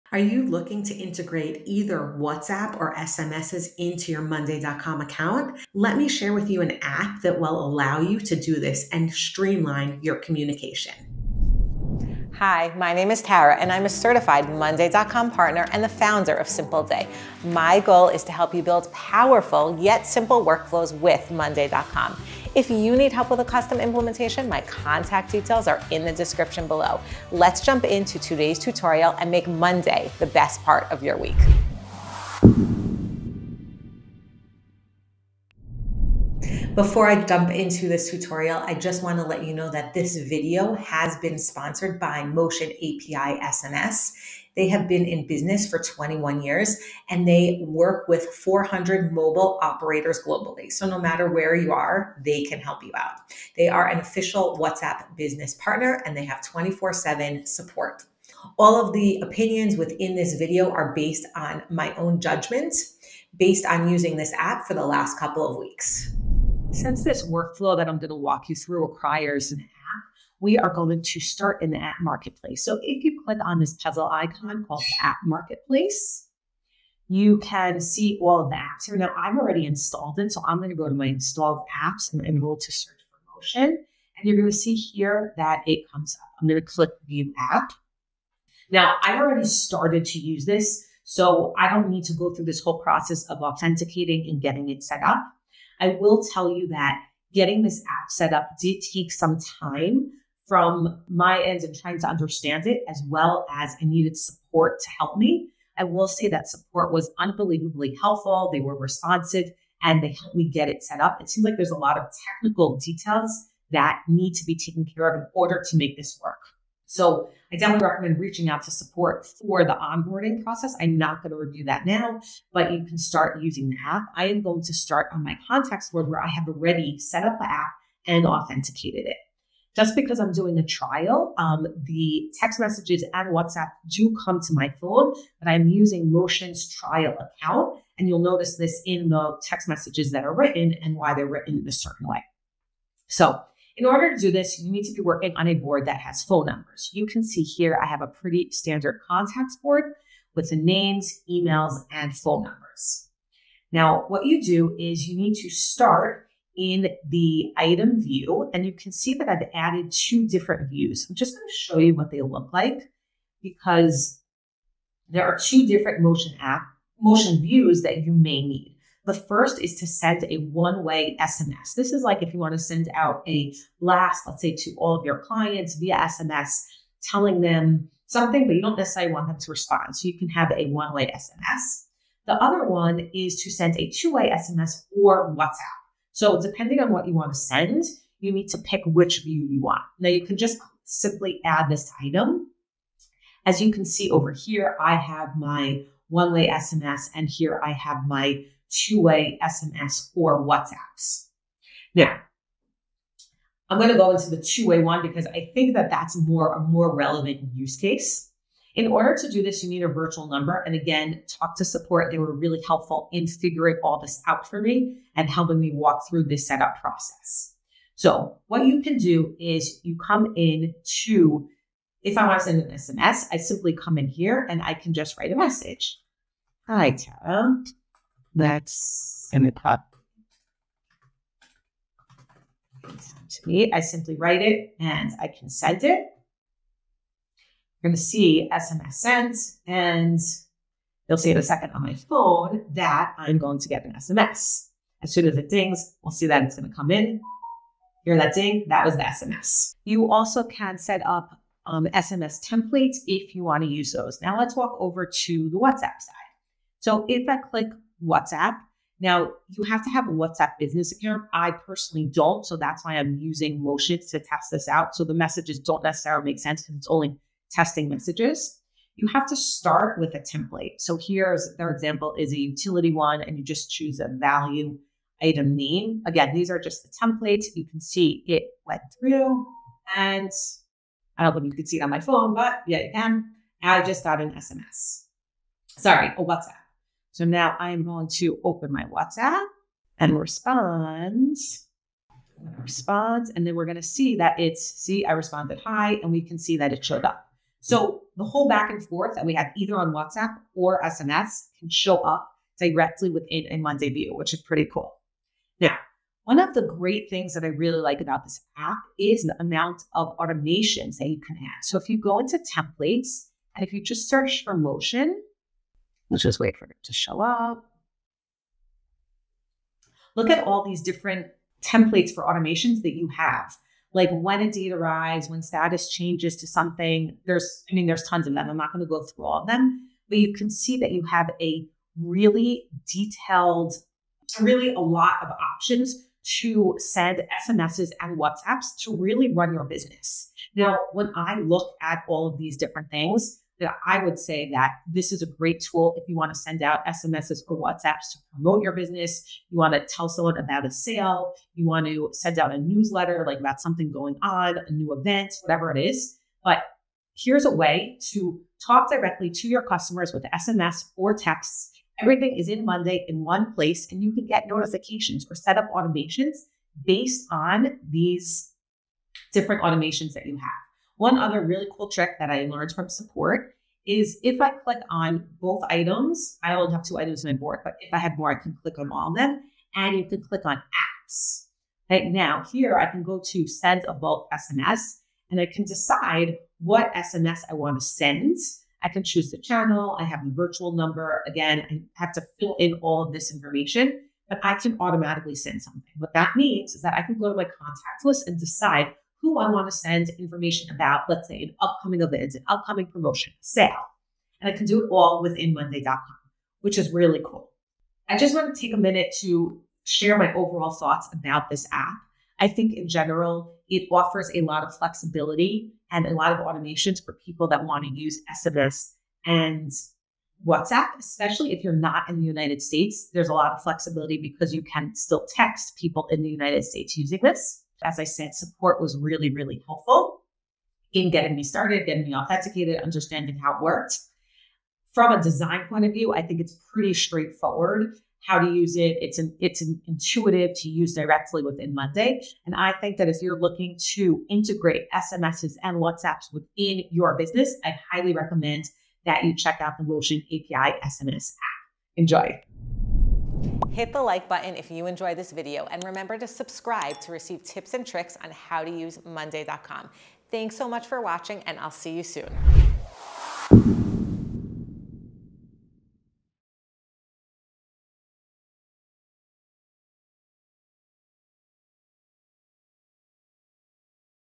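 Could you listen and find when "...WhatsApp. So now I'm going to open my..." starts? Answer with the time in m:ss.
4:46.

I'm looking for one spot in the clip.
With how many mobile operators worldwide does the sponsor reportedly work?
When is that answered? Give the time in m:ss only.
0:48.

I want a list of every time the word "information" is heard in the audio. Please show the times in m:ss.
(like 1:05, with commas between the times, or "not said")
6:33, 6:40.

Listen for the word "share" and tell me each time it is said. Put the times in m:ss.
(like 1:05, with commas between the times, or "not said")
0:06, 6:49.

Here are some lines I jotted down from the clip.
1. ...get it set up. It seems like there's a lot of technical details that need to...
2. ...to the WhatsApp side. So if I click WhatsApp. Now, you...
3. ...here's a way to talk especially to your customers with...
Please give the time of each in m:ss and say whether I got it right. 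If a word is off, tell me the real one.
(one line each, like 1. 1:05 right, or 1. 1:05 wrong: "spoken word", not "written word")
1. 1:50 right
2. 4:15 right
3. 5:57 wrong: "directly", not "especially".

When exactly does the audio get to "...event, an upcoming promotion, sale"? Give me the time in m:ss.
6:42.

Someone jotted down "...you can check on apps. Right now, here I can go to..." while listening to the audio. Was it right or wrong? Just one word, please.
wrong.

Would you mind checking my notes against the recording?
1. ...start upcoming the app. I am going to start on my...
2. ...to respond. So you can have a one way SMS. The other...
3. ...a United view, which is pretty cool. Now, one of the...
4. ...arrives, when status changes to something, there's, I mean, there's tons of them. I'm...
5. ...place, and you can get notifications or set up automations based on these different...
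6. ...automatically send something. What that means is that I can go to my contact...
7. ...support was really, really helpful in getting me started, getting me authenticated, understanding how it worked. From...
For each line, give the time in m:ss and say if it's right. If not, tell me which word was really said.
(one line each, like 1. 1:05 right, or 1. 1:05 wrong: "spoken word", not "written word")
1. 2:02 wrong: "using", not "upcoming"
2. 2:59 right
3. 5:03 wrong: "Monday", not "United"
4. 5:24 right
5. 6:03 right
6. 6:34 right
7. 7:08 right.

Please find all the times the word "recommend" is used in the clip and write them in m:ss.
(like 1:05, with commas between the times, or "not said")
1:57, 7:28.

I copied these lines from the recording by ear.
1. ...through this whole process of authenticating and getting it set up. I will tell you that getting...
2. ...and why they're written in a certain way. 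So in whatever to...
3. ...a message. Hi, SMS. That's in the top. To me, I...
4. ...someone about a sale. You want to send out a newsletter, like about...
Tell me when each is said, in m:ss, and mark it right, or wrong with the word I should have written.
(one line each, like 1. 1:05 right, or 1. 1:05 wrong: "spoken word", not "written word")
1. 1:32 right
2. 2:20 wrong: "order", not "whatever"
3. 3:45 wrong: "Tara", not "SMS"
4. 5:50 right.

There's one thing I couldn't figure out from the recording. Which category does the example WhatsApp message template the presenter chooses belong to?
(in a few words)
utility.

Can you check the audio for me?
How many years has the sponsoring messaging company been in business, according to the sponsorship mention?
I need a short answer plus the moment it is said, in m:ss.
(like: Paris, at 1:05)
21, at 0:45.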